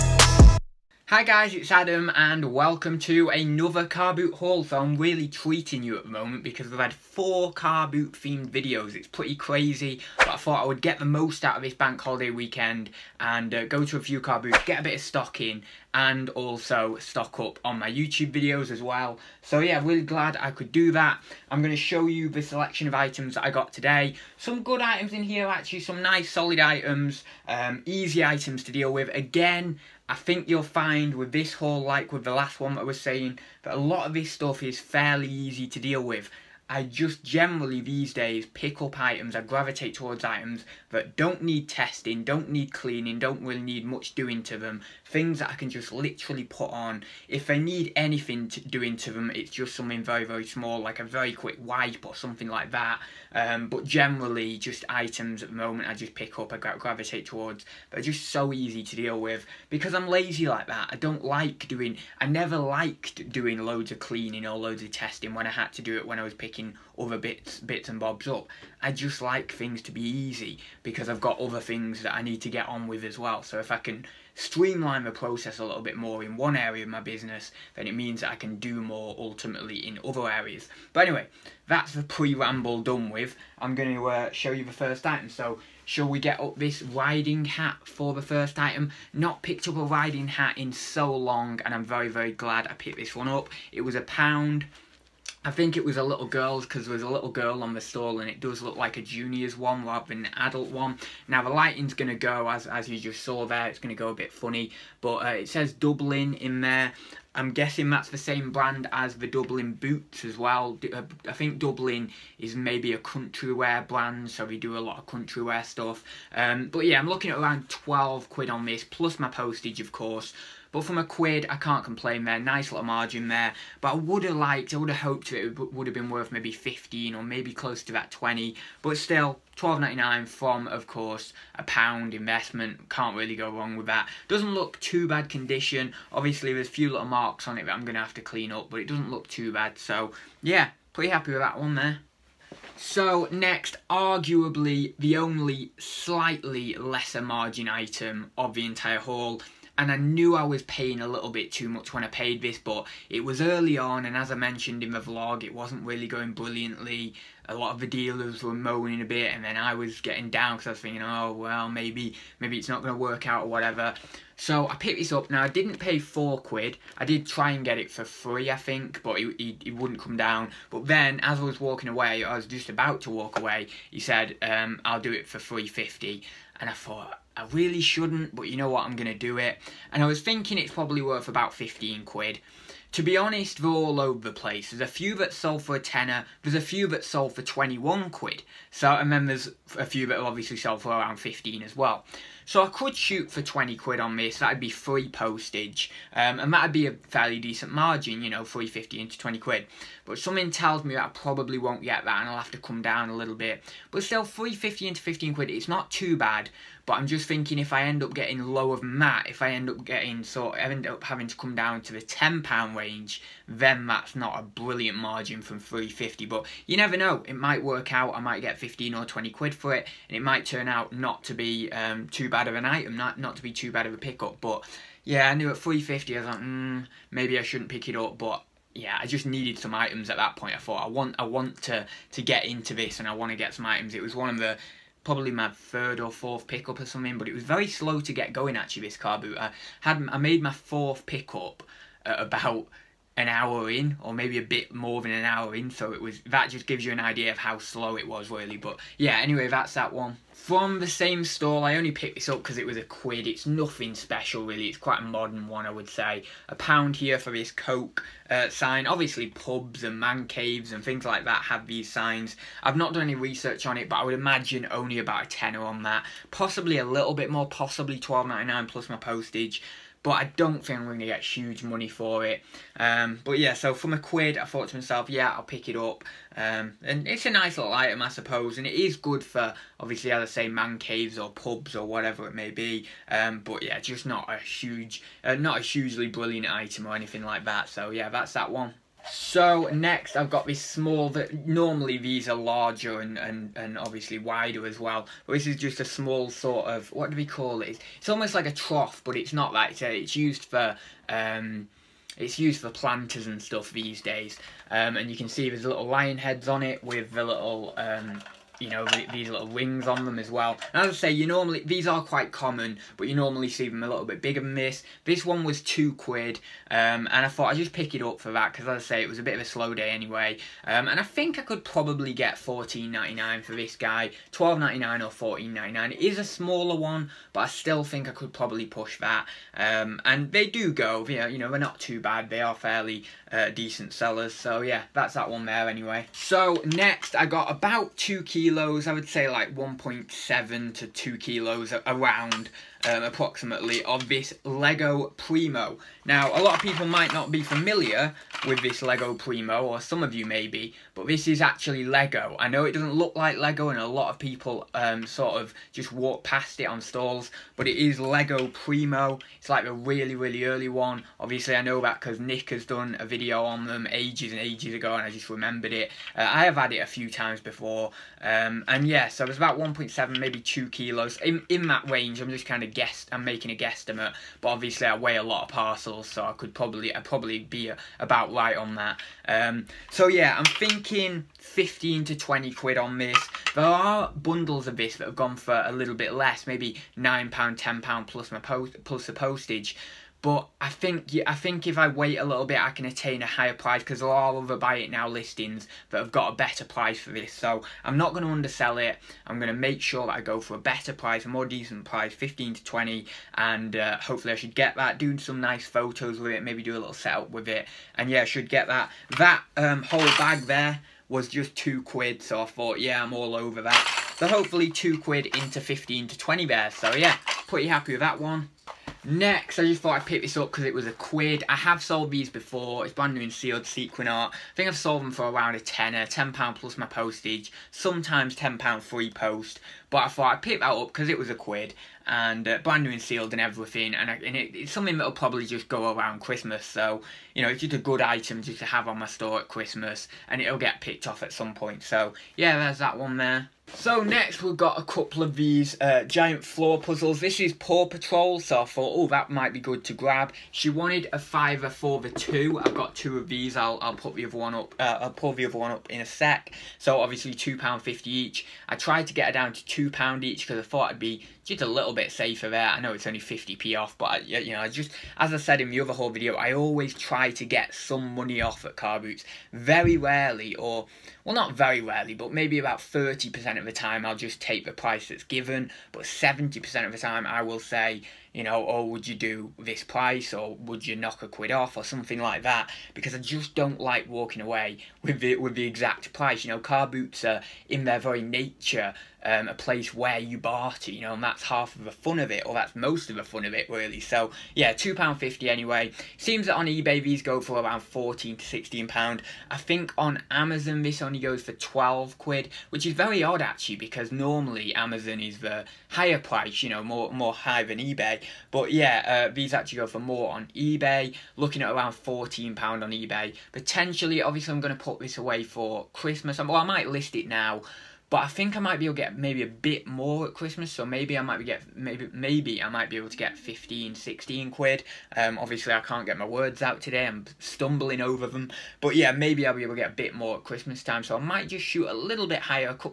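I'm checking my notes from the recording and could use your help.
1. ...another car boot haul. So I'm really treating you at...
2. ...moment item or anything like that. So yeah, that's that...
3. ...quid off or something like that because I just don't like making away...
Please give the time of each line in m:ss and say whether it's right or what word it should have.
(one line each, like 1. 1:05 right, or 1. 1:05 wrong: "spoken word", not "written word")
1. 0:03 right
2. 4:46 wrong: "brilliant", not "moment"
3. 8:01 wrong: "walking", not "making".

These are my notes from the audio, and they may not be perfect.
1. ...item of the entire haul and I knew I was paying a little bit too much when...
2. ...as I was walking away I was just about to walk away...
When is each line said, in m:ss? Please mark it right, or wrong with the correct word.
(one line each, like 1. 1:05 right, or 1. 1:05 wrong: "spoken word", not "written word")
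1. 2:27 right
2. 2:51 right.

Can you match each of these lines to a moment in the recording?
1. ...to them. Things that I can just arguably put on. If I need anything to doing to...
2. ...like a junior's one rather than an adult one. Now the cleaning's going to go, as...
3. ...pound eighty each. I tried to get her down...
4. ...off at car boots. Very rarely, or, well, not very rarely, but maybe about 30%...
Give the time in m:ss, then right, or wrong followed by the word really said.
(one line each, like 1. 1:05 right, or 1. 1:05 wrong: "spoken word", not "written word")
1. 0:44 wrong: "literally", not "arguably"
2. 1:38 wrong: "lighting", not "cleaning"
3. 7:37 wrong: "fifty", not "eighty"
4. 7:48 right.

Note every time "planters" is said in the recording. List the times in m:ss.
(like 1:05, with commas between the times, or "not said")
5:02.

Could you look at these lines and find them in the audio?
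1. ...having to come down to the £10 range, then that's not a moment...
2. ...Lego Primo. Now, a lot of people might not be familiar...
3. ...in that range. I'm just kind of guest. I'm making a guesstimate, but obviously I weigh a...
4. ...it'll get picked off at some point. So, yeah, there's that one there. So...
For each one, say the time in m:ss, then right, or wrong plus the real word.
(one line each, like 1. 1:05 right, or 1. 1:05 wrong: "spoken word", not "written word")
1. 3:31 wrong: "brilliant", not "moment"
2. 5:44 right
3. 6:11 right
4. 7:20 right.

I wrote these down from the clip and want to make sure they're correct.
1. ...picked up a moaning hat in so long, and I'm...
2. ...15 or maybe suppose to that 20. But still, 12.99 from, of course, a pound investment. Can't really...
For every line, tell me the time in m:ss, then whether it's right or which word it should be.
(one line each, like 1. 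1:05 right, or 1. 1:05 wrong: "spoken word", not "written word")
1. 1:29 wrong: "riding", not "moaning"
2. 2:06 wrong: "close", not "suppose".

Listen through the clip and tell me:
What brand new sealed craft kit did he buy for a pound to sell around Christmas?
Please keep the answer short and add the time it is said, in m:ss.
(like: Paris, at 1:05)
Sequin art, at 7:03.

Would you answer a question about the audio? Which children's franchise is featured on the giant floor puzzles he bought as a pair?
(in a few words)
Paw Patrol.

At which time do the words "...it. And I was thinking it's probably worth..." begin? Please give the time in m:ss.
2:59.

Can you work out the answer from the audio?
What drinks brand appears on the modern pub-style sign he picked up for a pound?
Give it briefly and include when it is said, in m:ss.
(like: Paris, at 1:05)
Coke, at 4:17.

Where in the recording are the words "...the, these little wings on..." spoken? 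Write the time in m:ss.
5:08.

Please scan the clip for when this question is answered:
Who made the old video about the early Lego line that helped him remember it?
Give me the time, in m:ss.
6:02.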